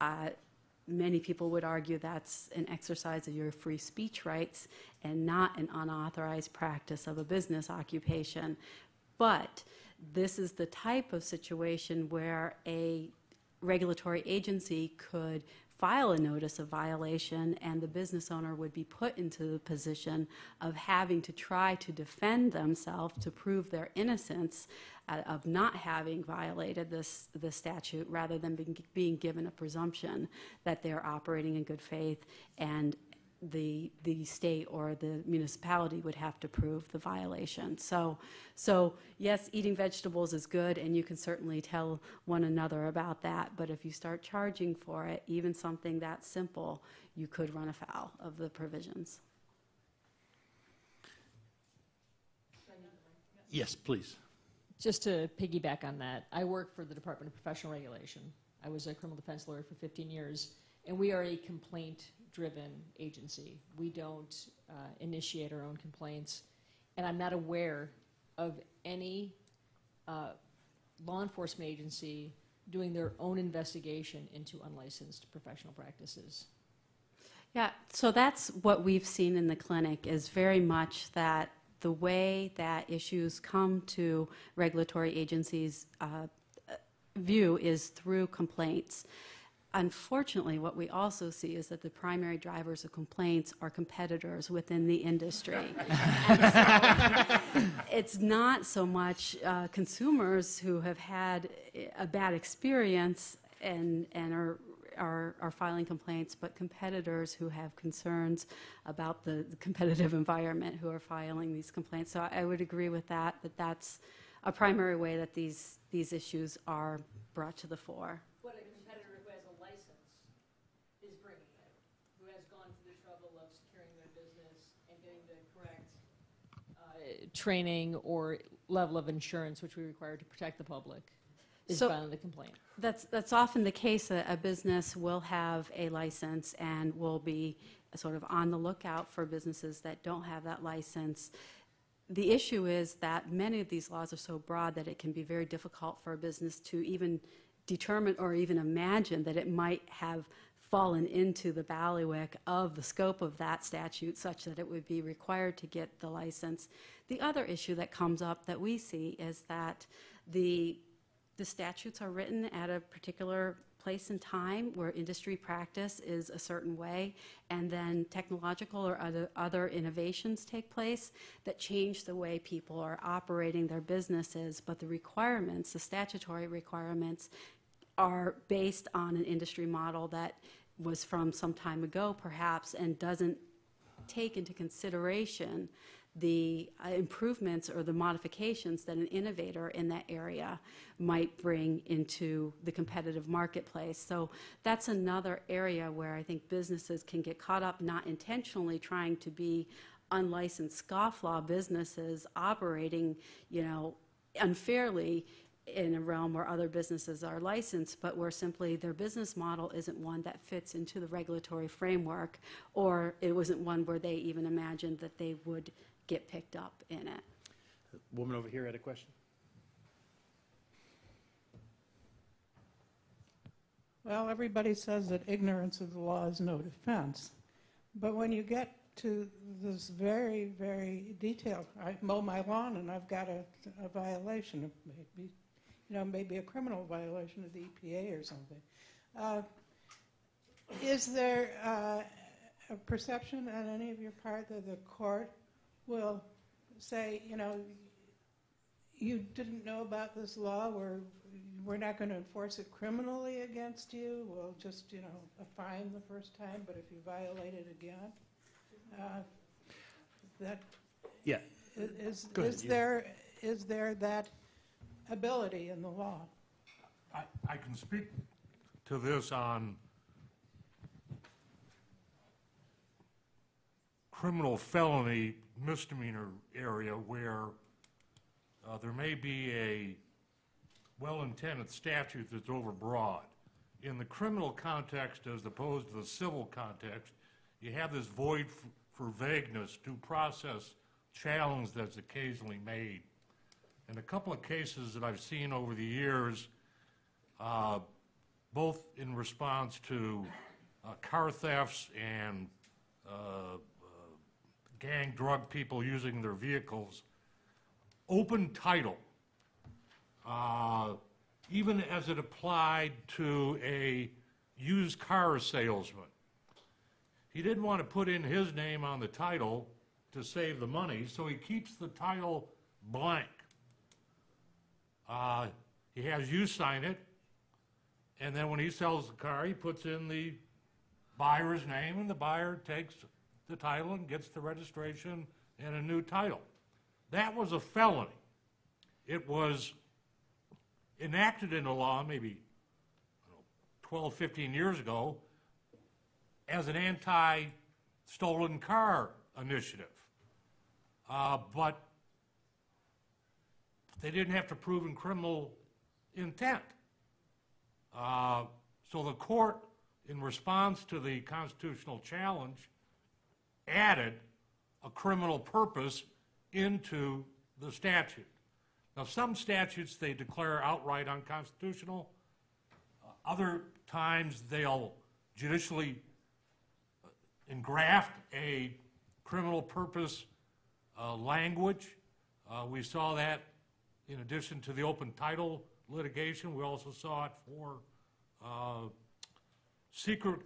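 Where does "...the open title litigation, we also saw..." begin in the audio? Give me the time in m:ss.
6:24.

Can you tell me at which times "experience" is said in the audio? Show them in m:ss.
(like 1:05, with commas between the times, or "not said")
1:42.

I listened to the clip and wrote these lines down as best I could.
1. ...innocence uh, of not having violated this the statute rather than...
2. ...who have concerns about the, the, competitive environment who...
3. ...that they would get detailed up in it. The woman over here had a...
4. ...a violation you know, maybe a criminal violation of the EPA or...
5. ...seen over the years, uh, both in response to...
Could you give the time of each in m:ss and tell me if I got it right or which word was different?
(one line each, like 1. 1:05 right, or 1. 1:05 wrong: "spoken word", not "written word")
1. 0:23 right
2. 1:47 right
3. 3:34 wrong: "picked", not "detailed"
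4. 3:53 right
5. 4:55 right.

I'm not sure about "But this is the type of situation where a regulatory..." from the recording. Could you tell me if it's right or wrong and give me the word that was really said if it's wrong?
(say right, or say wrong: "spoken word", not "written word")
right.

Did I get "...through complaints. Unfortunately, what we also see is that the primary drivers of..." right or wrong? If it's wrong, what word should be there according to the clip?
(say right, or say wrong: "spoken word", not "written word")
right.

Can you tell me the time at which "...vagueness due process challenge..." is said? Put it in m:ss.
4:49.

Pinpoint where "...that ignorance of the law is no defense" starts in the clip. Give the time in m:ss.
3:45.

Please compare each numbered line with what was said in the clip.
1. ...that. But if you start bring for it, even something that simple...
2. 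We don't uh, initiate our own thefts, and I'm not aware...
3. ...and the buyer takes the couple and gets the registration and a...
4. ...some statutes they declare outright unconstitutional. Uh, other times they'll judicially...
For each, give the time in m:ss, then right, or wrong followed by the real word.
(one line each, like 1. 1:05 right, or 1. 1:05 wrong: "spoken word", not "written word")
1. 0:43 wrong: "charging", not "bring"
2. 1:03 wrong: "complaints", not "thefts"
3. 5:31 wrong: "title", not "couple"
4. 6:09 right.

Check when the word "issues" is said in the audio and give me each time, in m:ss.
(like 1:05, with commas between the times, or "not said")
1:22, 1:56, 2:22, 2:37.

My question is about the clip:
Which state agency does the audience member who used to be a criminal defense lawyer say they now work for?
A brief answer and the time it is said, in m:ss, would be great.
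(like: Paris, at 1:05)
Department of Professional Regulation, at 0:56.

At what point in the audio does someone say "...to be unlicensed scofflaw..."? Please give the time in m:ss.
3:19.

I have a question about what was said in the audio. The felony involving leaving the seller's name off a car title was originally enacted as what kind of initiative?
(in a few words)
Anti stolen car initiative.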